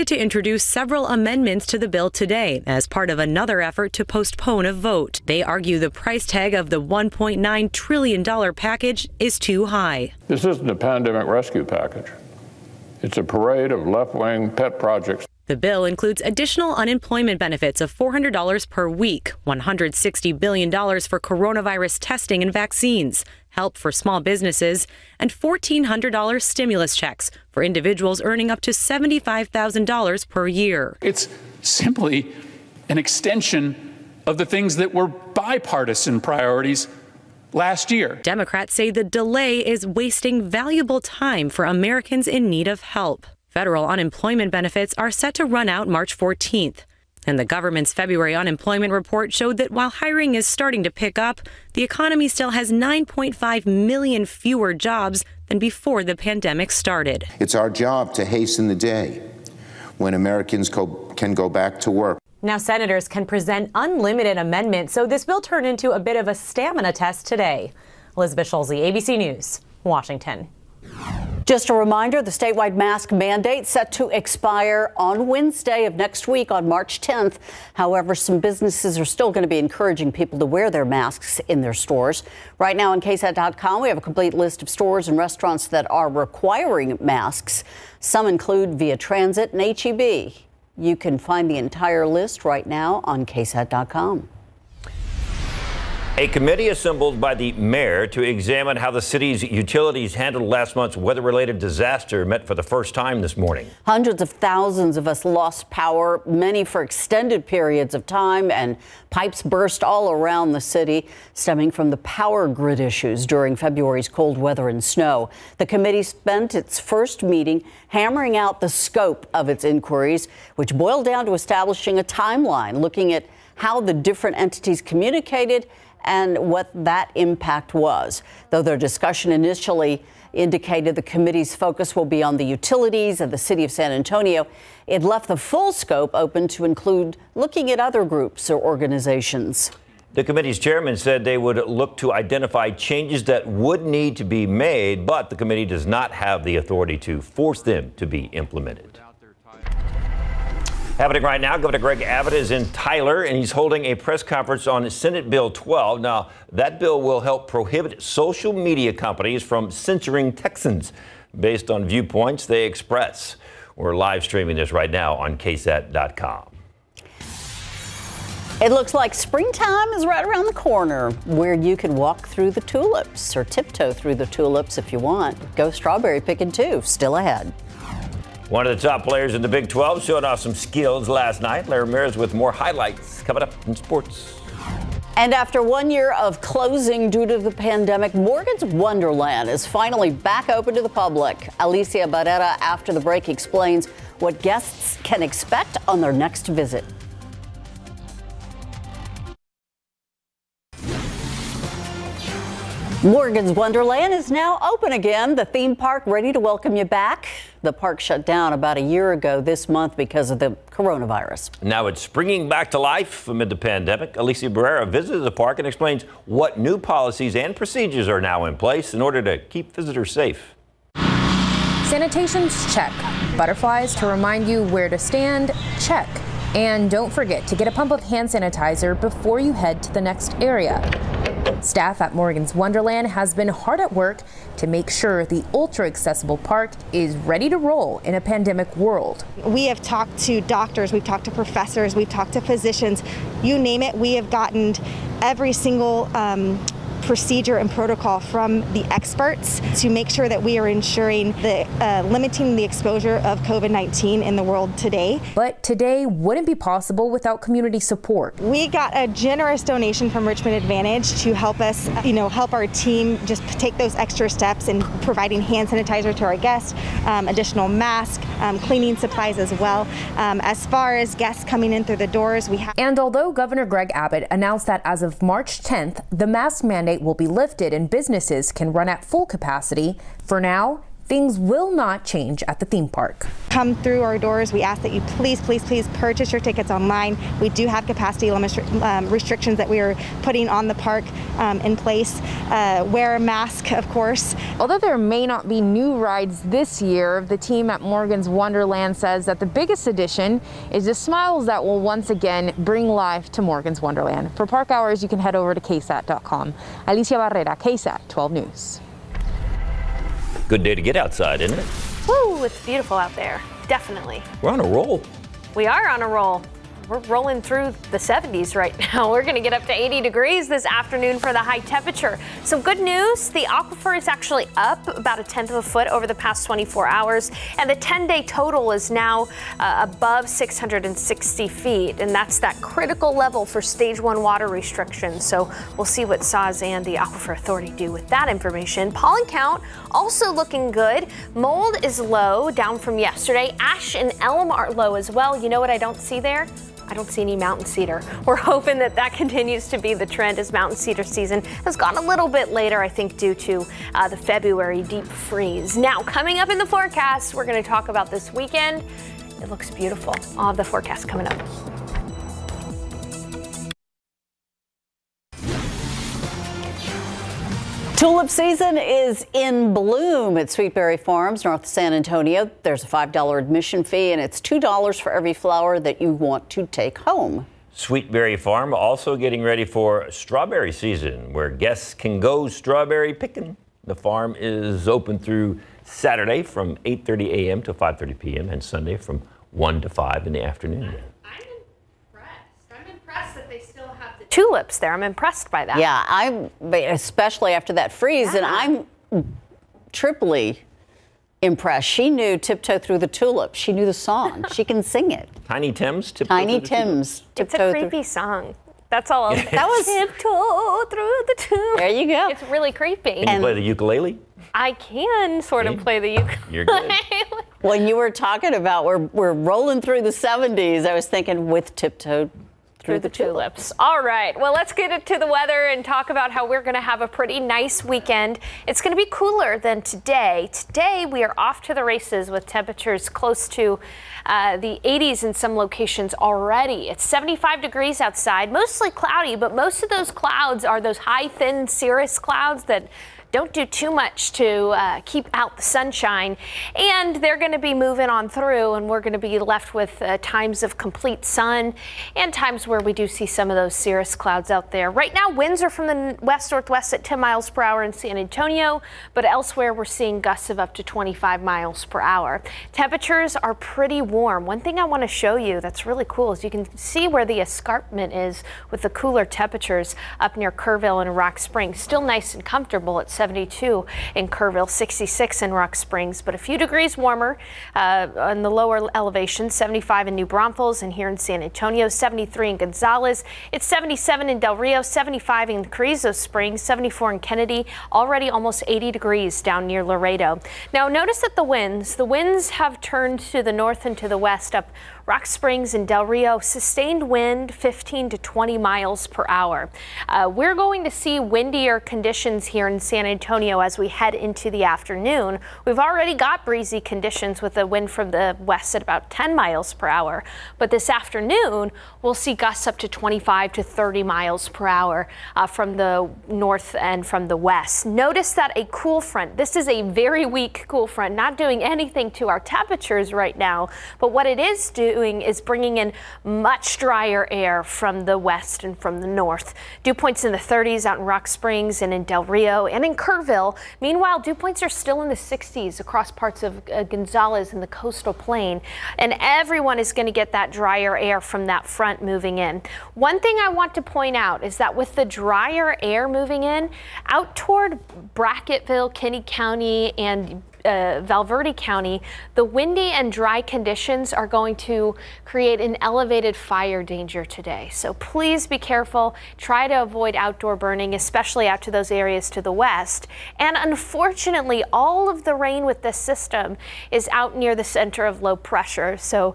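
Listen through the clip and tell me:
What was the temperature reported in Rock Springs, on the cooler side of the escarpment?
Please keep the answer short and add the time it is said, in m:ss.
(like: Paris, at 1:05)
66, at 7:54.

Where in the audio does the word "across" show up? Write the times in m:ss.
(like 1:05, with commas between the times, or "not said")
8:55.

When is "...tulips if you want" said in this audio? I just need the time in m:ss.
2:54.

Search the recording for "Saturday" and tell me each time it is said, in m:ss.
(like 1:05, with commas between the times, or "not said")
6:25.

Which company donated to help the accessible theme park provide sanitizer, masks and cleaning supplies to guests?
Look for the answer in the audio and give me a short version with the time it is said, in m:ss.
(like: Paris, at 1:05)
Richmond Advantage, at 4:20.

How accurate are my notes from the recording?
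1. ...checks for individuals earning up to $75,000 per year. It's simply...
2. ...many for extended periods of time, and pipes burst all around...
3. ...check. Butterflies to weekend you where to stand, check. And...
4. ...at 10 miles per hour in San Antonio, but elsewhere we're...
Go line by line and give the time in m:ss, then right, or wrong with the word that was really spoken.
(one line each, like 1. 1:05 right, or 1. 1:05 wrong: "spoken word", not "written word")
1. 0:26 right
2. 1:46 right
3. 3:42 wrong: "remind", not "weekend"
4. 7:36 right.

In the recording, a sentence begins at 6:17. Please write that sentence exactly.
Sweetberry Farm also getting ready for strawberry season, where guests can go strawberry picking.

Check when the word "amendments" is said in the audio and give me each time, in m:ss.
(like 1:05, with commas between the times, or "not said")
0:01, 1:04.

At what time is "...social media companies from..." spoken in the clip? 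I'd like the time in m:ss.
2:38.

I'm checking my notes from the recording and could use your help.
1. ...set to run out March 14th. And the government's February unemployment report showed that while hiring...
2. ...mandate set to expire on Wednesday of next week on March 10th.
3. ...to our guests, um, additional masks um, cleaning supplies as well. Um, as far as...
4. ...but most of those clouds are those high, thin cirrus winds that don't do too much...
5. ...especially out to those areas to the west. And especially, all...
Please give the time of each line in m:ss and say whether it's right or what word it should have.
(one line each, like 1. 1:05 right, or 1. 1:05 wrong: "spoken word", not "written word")
1. 0:45 right
2. 1:13 right
3. 4:26 right
4. 7:19 wrong: "clouds", not "winds"
5. 9:20 wrong: "unfortunately", not "especially".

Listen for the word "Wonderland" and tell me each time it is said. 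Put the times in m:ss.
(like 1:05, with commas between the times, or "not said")
3:08, 3:23, 3:52, 4:58, 5:03.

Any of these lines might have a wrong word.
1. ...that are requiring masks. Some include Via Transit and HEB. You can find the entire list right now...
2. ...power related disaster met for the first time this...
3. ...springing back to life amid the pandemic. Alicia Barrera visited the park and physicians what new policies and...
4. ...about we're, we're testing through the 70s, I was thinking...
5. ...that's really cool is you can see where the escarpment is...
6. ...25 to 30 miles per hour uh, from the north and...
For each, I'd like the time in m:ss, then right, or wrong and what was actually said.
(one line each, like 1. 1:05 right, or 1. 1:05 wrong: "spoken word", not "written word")
1. 1:25 right
2. 1:40 wrong: "weather", not "power"
3. 3:32 wrong: "explains", not "physicians"
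4. 6:58 wrong: "rolling", not "testing"
5. 7:45 right
6. 8:32 right.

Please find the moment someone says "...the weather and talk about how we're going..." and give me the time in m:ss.
7:05.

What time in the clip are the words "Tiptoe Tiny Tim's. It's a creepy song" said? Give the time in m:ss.
6:46.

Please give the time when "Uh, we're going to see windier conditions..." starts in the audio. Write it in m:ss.
8:20.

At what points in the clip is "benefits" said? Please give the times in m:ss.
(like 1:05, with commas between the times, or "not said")
0:17, 0:44.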